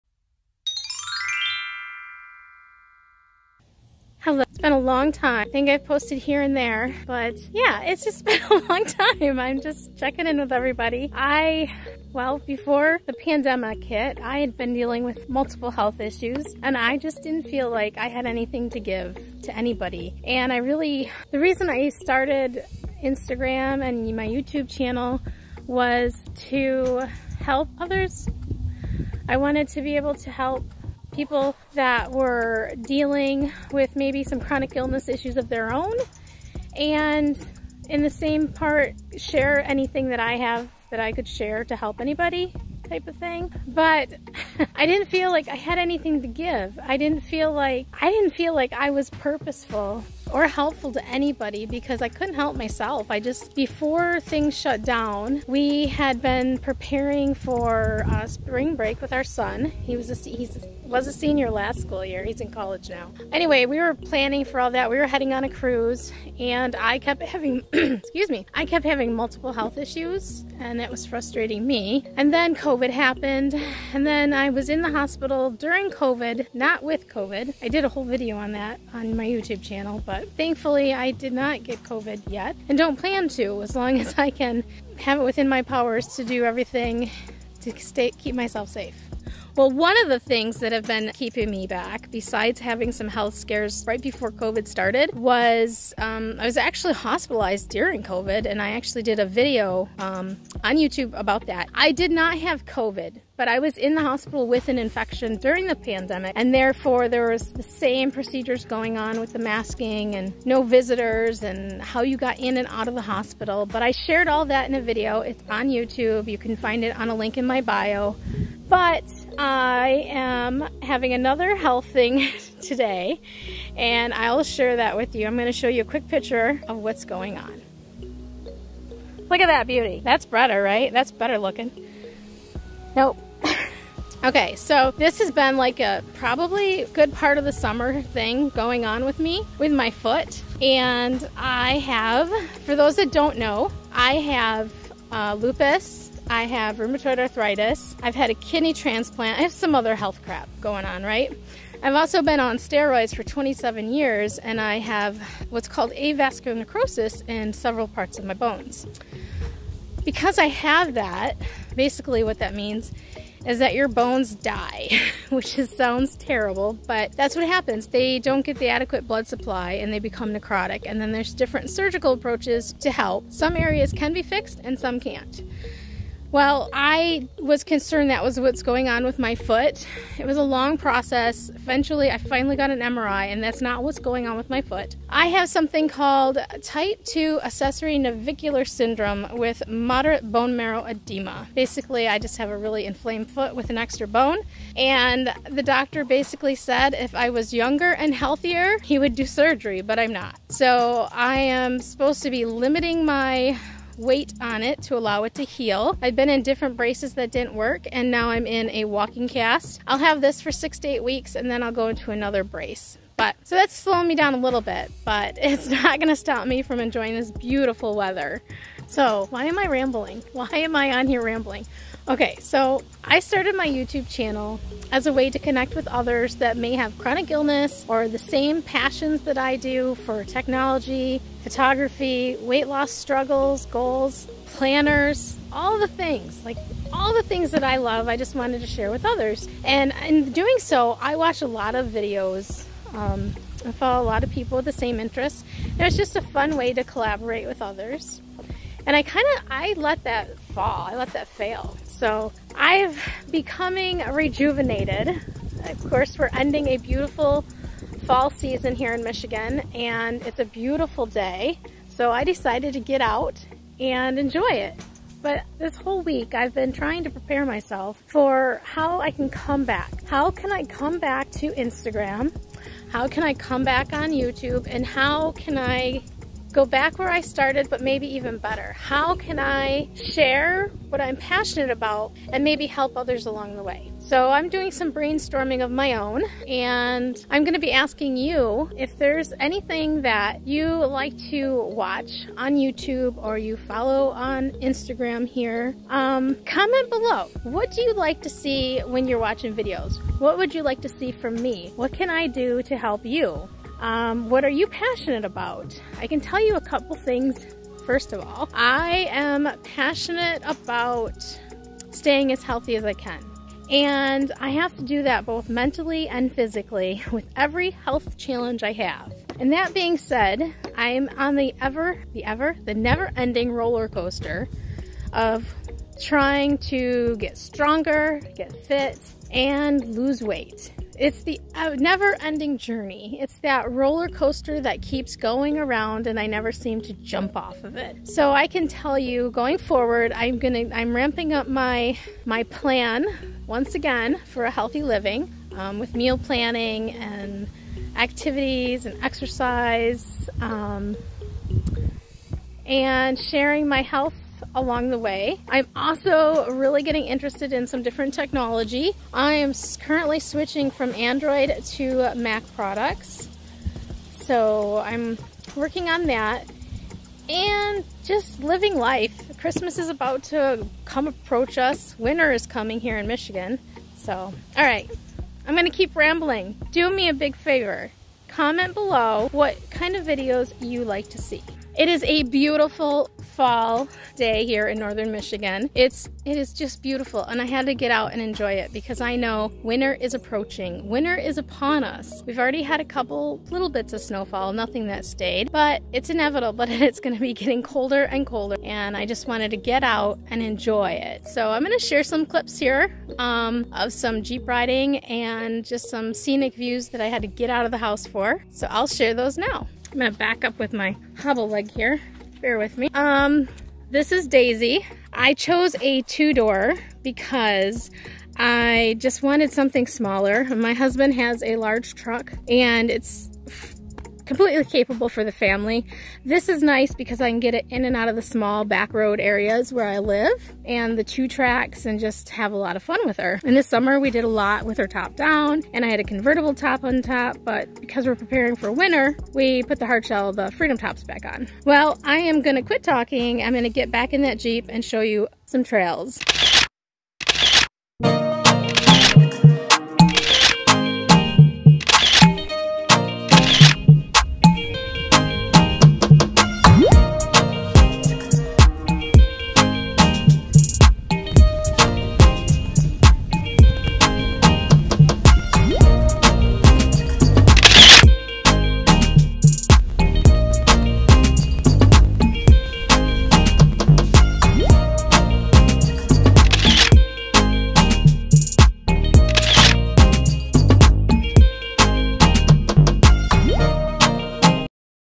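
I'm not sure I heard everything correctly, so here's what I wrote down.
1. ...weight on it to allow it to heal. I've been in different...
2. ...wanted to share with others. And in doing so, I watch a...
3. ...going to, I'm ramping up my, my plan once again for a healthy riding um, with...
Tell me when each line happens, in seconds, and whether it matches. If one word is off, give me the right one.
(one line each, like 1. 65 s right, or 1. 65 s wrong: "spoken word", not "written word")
1. 203 s right
2. 238 s right
3. 340 s wrong: "living", not "riding".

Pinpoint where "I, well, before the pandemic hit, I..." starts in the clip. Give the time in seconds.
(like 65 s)
11 s.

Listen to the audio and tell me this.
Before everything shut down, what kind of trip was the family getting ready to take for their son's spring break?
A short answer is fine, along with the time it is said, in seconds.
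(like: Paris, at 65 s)
cruise, at 65 s.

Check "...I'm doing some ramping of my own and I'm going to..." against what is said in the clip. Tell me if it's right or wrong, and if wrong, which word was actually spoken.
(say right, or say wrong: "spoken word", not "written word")
wrong: "brainstorming", not "ramping".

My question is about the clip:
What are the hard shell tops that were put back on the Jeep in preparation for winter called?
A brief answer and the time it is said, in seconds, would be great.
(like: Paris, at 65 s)
freedom tops, at 440 s.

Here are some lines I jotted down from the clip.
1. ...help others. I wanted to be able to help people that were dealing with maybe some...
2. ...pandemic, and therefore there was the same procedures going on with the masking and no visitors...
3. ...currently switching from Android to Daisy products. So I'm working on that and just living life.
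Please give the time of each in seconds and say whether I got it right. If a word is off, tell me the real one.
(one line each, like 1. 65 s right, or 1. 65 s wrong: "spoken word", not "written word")
1. 27 s right
2. 105 s right
3. 359 s wrong: "Mac", not "Daisy".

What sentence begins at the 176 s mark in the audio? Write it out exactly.
Well, I was concerned that was what's going on with my foot.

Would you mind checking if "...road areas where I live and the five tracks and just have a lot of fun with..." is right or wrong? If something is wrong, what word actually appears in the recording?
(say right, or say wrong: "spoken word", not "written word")
wrong: "two", not "five".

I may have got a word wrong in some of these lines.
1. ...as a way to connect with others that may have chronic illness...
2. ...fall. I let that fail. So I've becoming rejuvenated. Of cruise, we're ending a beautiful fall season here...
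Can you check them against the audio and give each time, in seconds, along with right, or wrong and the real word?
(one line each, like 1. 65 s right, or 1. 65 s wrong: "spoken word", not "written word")
1. 224 s right
2. 250 s wrong: "course", not "cruise".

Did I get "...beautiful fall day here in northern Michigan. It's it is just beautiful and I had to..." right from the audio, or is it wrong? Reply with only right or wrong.
right.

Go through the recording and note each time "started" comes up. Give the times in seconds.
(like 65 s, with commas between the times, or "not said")
21 s, 94 s, 223 s, 277 s.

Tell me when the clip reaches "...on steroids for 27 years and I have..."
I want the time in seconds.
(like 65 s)
152 s.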